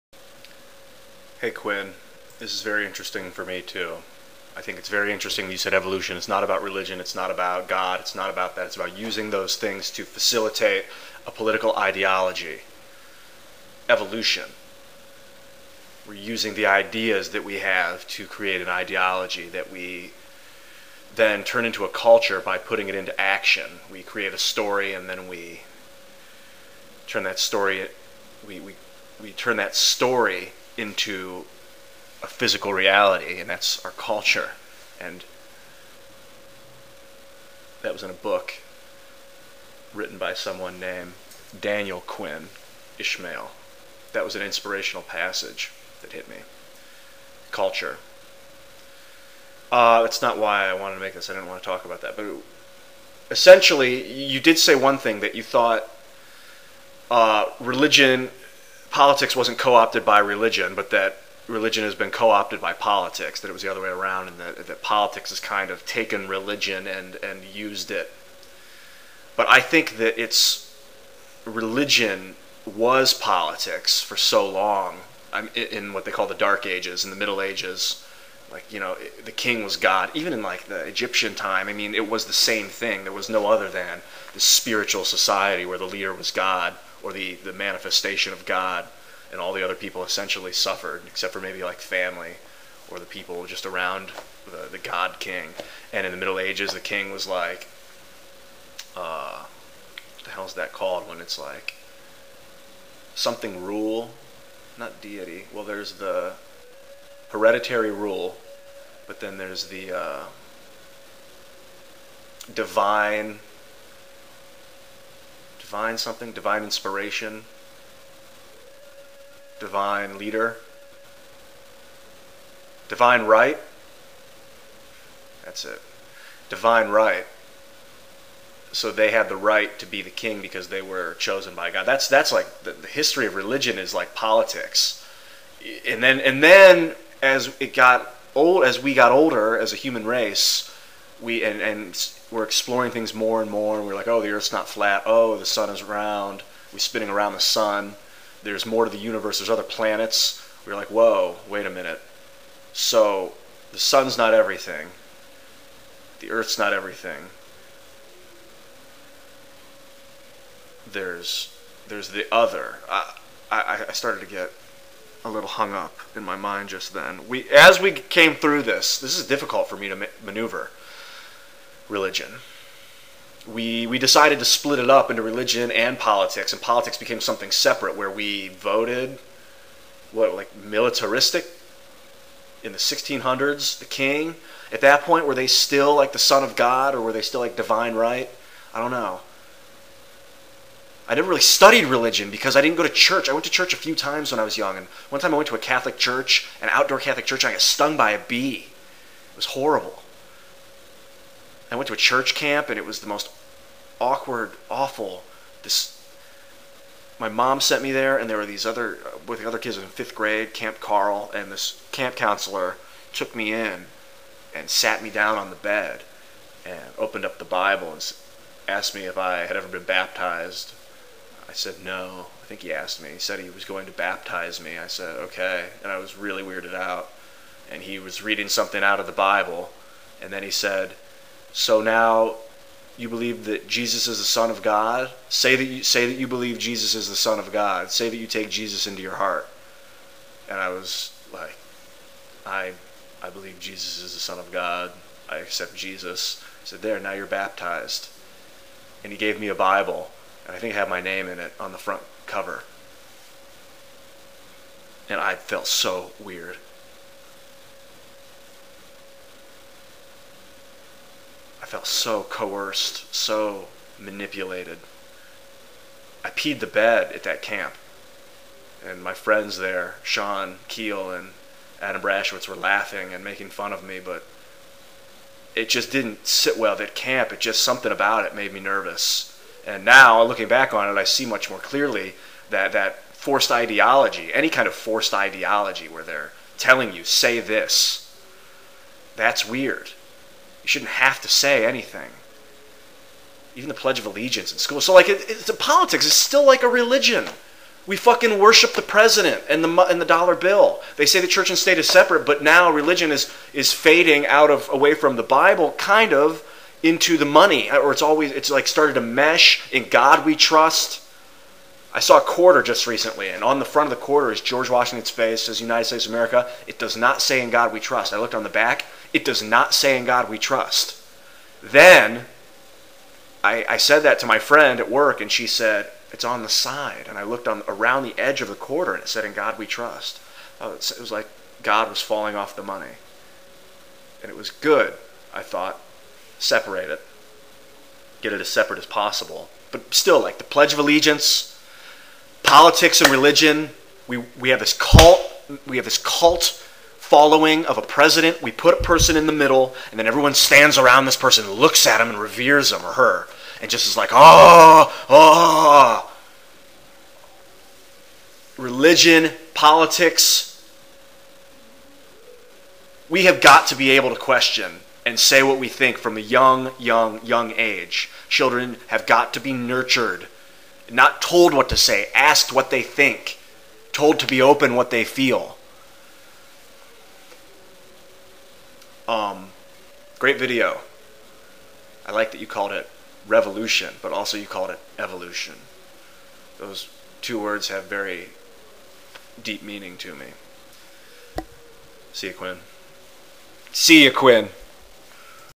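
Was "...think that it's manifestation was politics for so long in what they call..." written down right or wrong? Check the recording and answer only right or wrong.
wrong.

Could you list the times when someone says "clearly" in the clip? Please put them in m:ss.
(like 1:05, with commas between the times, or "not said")
4:41.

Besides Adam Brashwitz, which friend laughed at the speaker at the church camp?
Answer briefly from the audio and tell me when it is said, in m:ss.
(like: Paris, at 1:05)
Sean Keel, at 4:30.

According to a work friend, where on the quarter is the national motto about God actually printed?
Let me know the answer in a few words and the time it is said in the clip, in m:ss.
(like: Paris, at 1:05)
On the side, at 5:26.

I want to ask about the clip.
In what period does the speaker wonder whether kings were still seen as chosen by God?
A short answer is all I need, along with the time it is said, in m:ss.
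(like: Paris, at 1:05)
1600s, at 3:02.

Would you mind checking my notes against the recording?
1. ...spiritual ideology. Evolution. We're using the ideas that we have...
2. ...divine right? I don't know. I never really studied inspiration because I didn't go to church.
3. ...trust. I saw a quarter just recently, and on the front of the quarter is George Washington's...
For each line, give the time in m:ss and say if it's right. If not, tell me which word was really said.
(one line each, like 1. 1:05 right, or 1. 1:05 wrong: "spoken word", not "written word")
1. 0:11 wrong: "political", not "spiritual"
2. 3:07 wrong: "religion", not "inspiration"
3. 5:10 right.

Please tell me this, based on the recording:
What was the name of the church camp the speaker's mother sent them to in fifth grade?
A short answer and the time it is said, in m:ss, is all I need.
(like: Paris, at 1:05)
Camp Carl, at 3:30.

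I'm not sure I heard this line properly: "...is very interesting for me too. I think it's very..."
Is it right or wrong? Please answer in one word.
right.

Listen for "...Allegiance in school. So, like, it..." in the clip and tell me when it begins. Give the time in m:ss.
4:54.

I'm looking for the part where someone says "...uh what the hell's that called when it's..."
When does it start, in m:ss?
1:38.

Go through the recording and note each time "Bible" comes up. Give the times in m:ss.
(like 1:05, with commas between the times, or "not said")
3:37, 3:49, 4:09, 5:05.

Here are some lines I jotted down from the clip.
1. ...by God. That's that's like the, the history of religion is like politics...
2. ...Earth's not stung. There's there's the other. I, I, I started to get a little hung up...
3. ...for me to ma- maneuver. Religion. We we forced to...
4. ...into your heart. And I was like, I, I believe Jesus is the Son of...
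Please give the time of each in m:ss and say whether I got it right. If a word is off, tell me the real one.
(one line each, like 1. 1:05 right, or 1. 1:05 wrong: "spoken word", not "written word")
1. 2:11 right
2. 2:36 wrong: "everything", not "stung"
3. 2:49 wrong: "decided", not "forced"
4. 3:58 right.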